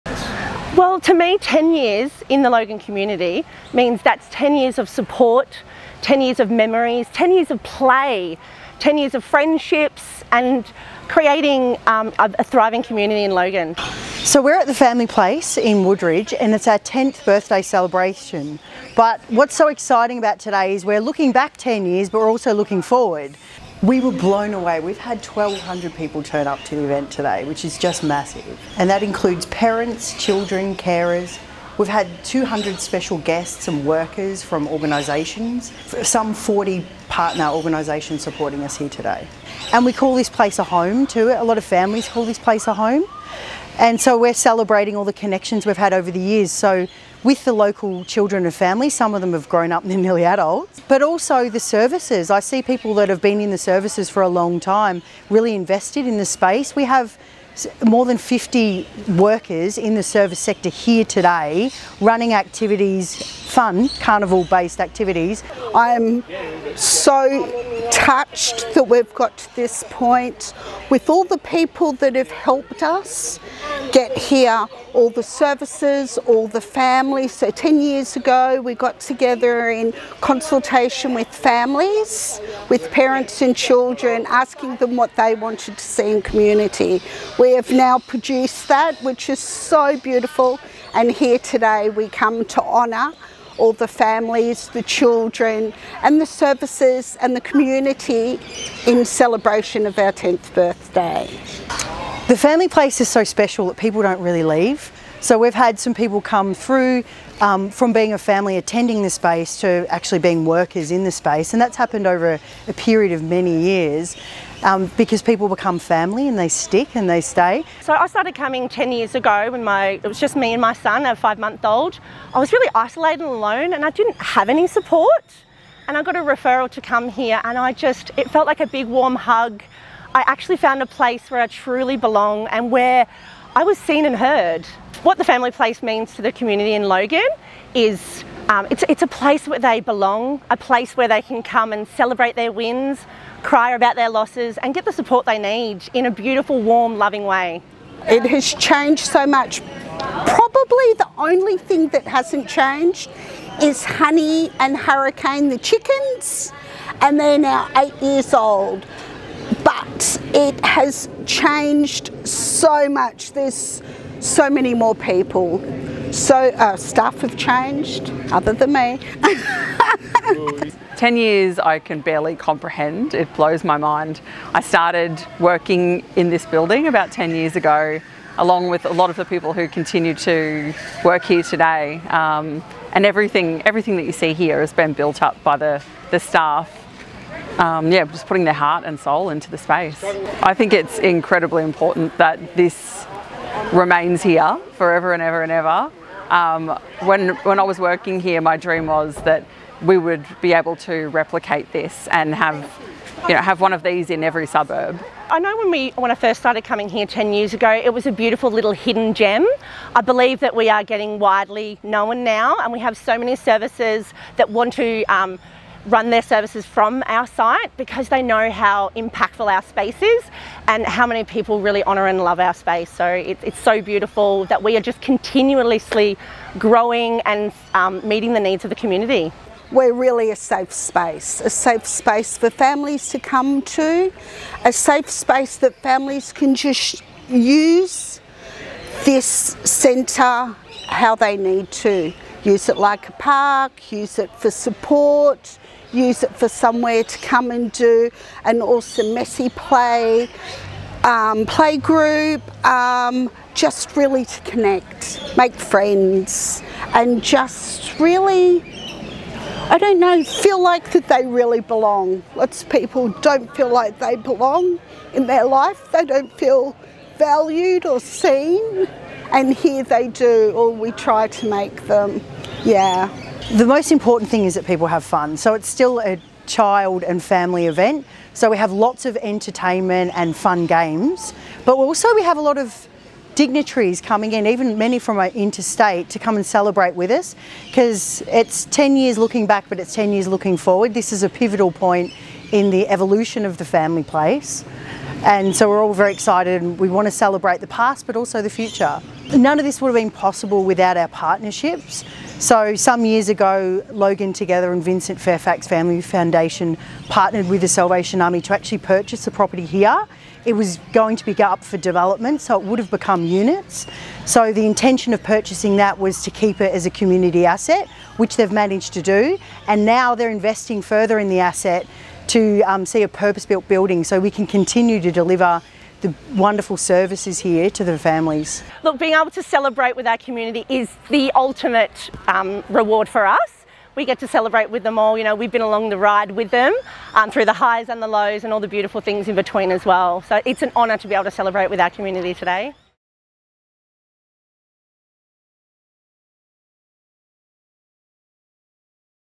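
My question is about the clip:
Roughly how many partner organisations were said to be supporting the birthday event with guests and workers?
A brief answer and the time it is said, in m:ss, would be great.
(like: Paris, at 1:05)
40, at 0:36.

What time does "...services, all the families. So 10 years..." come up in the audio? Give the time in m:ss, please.
1:15.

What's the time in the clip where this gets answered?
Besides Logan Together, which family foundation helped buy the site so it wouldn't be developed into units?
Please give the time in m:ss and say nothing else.
5:04.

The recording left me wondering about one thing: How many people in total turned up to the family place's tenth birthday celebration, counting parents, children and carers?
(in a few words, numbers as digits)
1,200.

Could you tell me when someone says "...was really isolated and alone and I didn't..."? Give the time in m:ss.
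2:02.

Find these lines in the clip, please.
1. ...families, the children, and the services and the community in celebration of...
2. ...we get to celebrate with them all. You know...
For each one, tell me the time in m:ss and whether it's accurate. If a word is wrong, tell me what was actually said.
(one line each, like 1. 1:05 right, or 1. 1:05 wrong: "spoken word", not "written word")
1. 1:33 right
2. 5:33 right.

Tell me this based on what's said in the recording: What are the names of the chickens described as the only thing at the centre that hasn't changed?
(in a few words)
Honey and Hurricane.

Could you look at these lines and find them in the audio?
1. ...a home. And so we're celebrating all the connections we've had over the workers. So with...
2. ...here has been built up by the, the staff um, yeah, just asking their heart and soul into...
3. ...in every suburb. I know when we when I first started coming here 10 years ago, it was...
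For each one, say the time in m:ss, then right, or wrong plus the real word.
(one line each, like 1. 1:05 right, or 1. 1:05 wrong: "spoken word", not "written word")
1. 0:42 wrong: "years", not "workers"
2. 3:04 wrong: "putting", not "asking"
3. 3:24 right.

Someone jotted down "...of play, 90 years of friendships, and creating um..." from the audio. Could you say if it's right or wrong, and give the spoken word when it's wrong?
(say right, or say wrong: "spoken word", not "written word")
wrong: "10", not "90".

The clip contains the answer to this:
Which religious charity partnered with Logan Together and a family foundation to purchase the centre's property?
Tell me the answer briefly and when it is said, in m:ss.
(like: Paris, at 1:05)
The Salvation Army, at 5:07.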